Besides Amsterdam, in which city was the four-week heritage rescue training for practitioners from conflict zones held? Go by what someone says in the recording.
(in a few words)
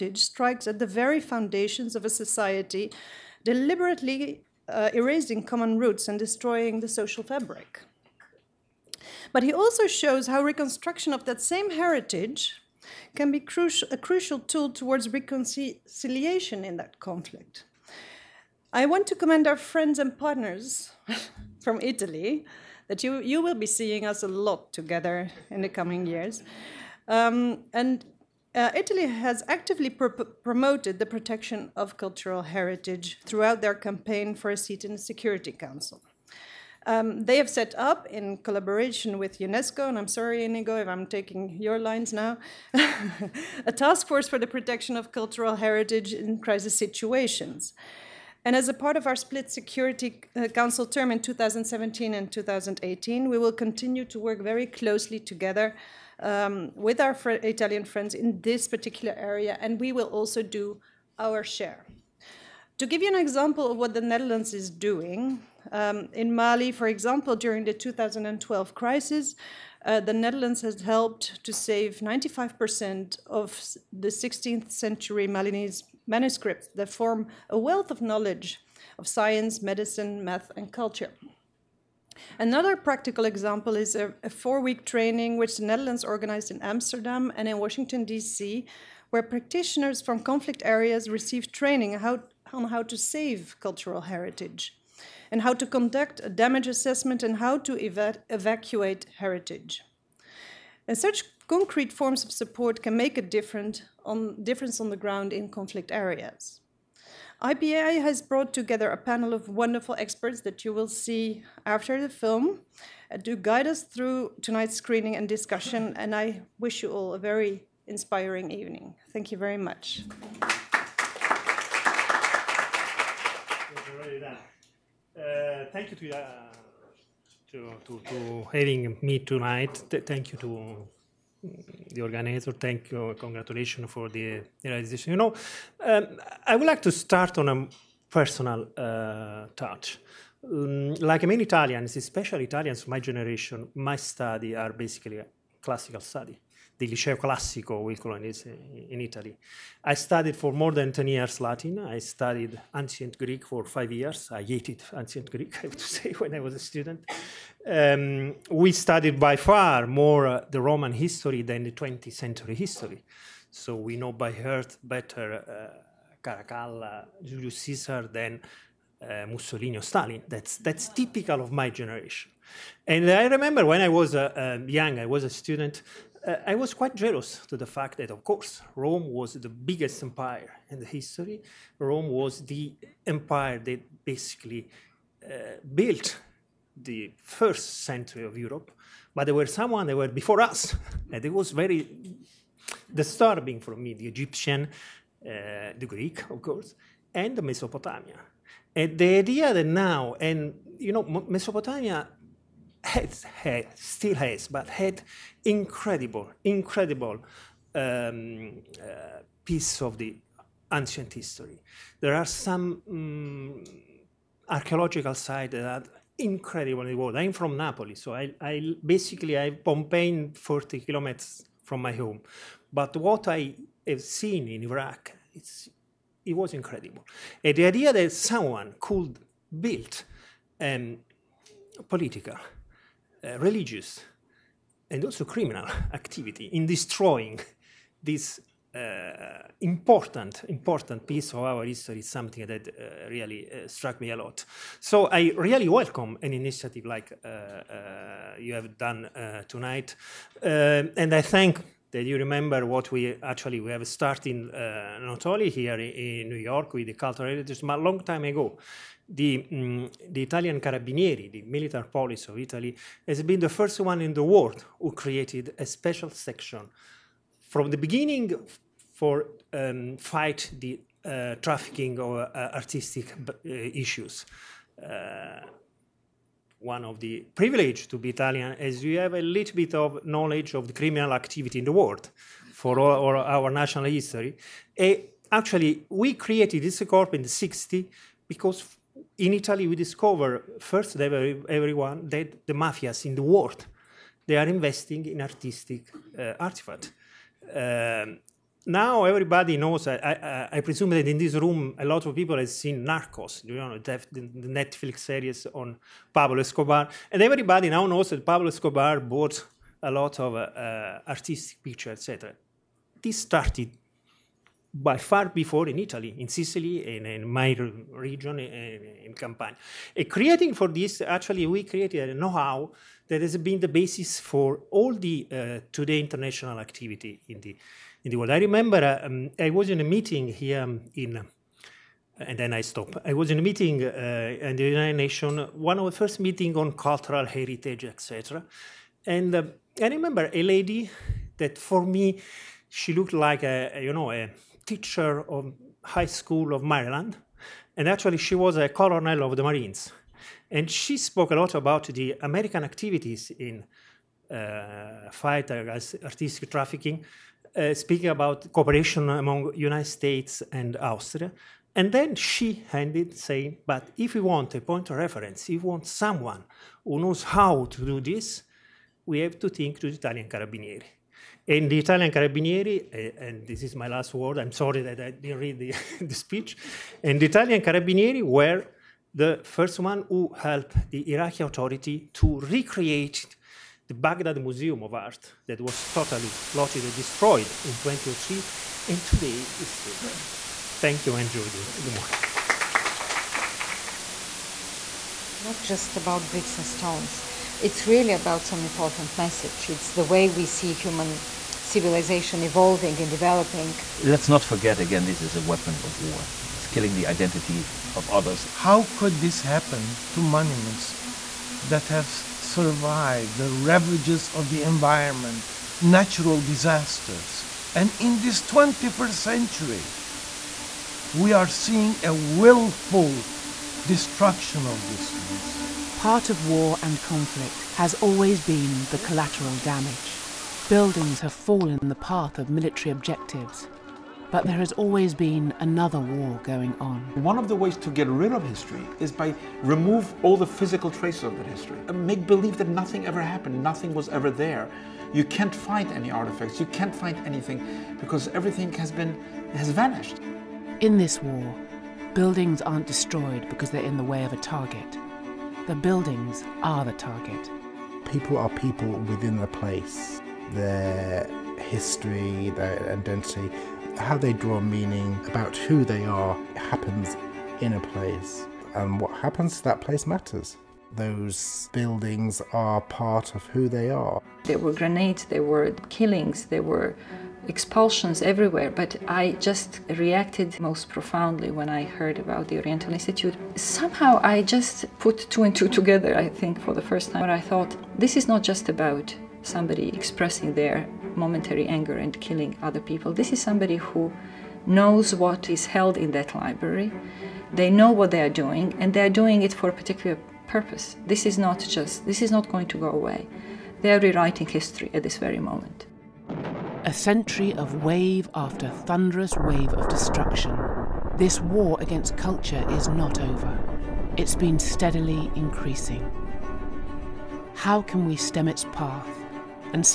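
Washington, D.C.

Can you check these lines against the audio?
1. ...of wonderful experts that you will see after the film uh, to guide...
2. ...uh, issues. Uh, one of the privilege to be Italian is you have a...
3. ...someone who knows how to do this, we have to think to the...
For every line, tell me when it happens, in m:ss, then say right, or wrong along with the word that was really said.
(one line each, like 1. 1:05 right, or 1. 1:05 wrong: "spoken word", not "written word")
1. 1:49 right
2. 4:33 right
3. 6:05 right.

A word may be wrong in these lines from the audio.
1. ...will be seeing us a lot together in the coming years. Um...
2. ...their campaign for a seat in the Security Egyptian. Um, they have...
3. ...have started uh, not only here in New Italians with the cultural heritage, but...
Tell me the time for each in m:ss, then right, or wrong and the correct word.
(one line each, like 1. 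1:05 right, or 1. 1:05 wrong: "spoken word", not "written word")
1. 0:23 right
2. 0:33 wrong: "Council", not "Egyptian"
3. 4:13 wrong: "York", not "Italians".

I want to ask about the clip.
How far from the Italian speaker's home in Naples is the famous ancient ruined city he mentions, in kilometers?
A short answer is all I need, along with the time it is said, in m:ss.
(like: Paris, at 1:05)
40, at 3:40.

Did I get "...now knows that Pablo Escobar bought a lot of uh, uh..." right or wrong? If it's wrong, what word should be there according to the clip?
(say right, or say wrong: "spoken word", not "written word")
right.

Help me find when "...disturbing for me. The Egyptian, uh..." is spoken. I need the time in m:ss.
3:12.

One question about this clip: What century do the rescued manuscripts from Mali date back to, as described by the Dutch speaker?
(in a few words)
16th century.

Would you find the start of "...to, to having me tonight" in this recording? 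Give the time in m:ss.
2:07.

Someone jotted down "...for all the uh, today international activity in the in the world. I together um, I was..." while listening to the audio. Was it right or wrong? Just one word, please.
wrong.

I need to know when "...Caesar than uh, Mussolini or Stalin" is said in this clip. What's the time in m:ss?
2:47.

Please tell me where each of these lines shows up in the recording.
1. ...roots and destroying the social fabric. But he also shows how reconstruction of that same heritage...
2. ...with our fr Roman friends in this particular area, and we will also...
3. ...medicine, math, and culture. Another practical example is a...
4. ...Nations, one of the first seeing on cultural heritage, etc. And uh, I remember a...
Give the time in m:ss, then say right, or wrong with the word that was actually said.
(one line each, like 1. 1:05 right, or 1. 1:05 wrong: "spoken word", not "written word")
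1. 0:05 right
2. 0:56 wrong: "Italian", not "Roman"
3. 1:19 right
4. 5:35 wrong: "meeting", not "seeing".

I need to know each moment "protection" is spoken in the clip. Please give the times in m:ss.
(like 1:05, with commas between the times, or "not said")
0:31, 0:44.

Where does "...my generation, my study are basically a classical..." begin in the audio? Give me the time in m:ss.
2:22.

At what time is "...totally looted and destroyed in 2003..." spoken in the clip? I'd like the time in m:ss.
6:25.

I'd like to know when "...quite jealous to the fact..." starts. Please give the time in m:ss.
2:56.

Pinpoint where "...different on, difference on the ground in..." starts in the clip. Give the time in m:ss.
1:43.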